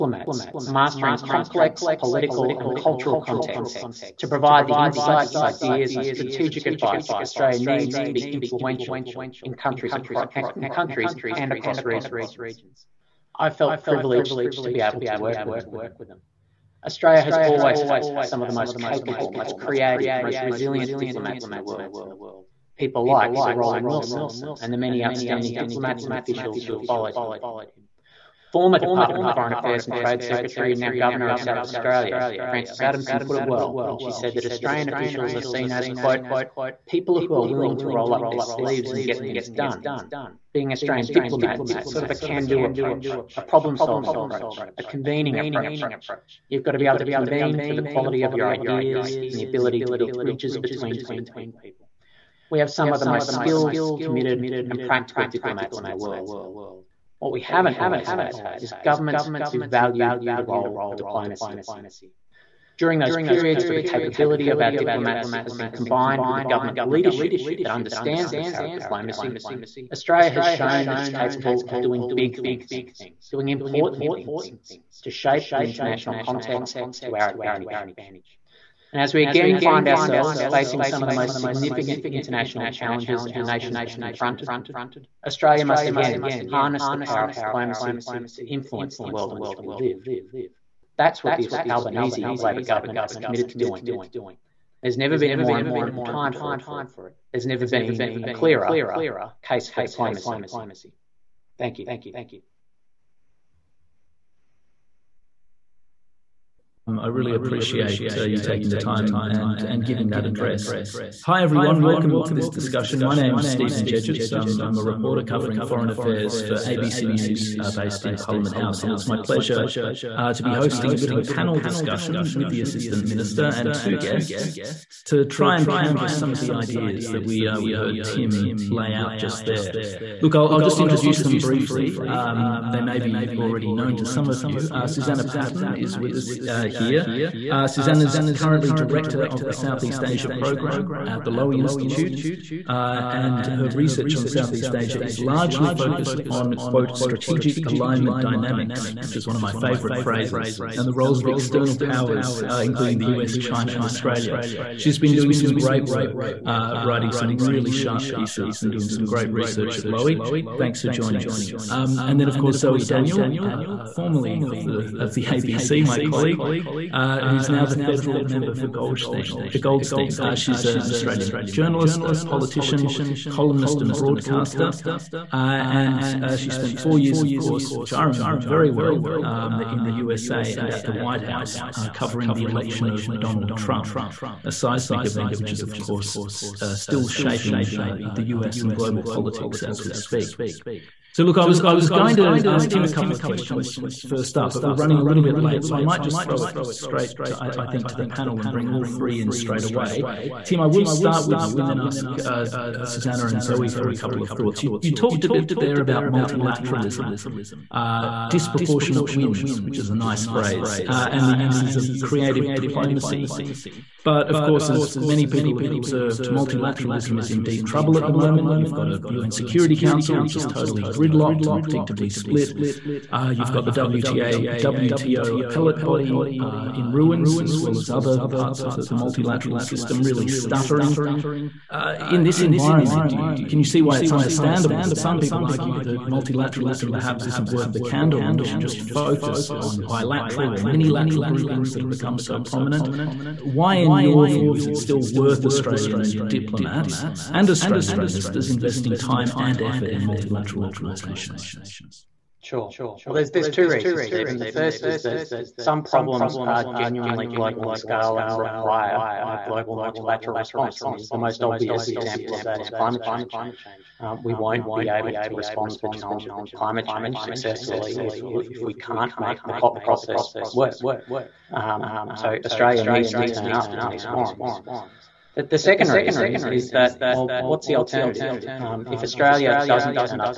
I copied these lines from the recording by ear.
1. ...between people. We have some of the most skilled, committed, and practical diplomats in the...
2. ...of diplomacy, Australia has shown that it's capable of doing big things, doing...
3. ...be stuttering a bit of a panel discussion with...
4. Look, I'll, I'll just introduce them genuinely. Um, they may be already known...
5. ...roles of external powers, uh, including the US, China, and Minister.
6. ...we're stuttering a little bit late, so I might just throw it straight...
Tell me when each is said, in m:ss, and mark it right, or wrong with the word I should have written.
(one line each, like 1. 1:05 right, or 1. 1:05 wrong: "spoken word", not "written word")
1. 0:50 right
2. 1:08 right
3. 2:00 wrong: "hosting", not "stuttering"
4. 2:10 wrong: "briefly", not "genuinely"
5. 2:30 wrong: "Australia", not "Minister"
6. 3:14 wrong: "running", not "stuttering".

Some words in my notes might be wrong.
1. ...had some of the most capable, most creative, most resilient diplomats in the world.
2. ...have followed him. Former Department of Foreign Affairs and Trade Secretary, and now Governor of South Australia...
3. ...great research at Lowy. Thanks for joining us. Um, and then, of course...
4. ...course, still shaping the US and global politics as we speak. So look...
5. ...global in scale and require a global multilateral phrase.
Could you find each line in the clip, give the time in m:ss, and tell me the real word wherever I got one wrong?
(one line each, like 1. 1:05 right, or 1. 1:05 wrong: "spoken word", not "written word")
1. 0:17 right
2. 0:26 right
3. 2:39 right
4. 3:05 right
5. 4:17 wrong: "response", not "phrase".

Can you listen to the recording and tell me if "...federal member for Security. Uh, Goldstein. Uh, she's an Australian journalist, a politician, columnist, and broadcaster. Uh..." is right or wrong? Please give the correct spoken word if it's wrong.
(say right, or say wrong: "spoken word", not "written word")
wrong: "Goldstein", not "Security".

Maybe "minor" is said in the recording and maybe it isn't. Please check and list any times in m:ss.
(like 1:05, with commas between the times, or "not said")
not said.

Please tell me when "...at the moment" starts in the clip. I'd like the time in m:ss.
3:37.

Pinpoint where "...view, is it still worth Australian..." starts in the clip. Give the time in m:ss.
4:04.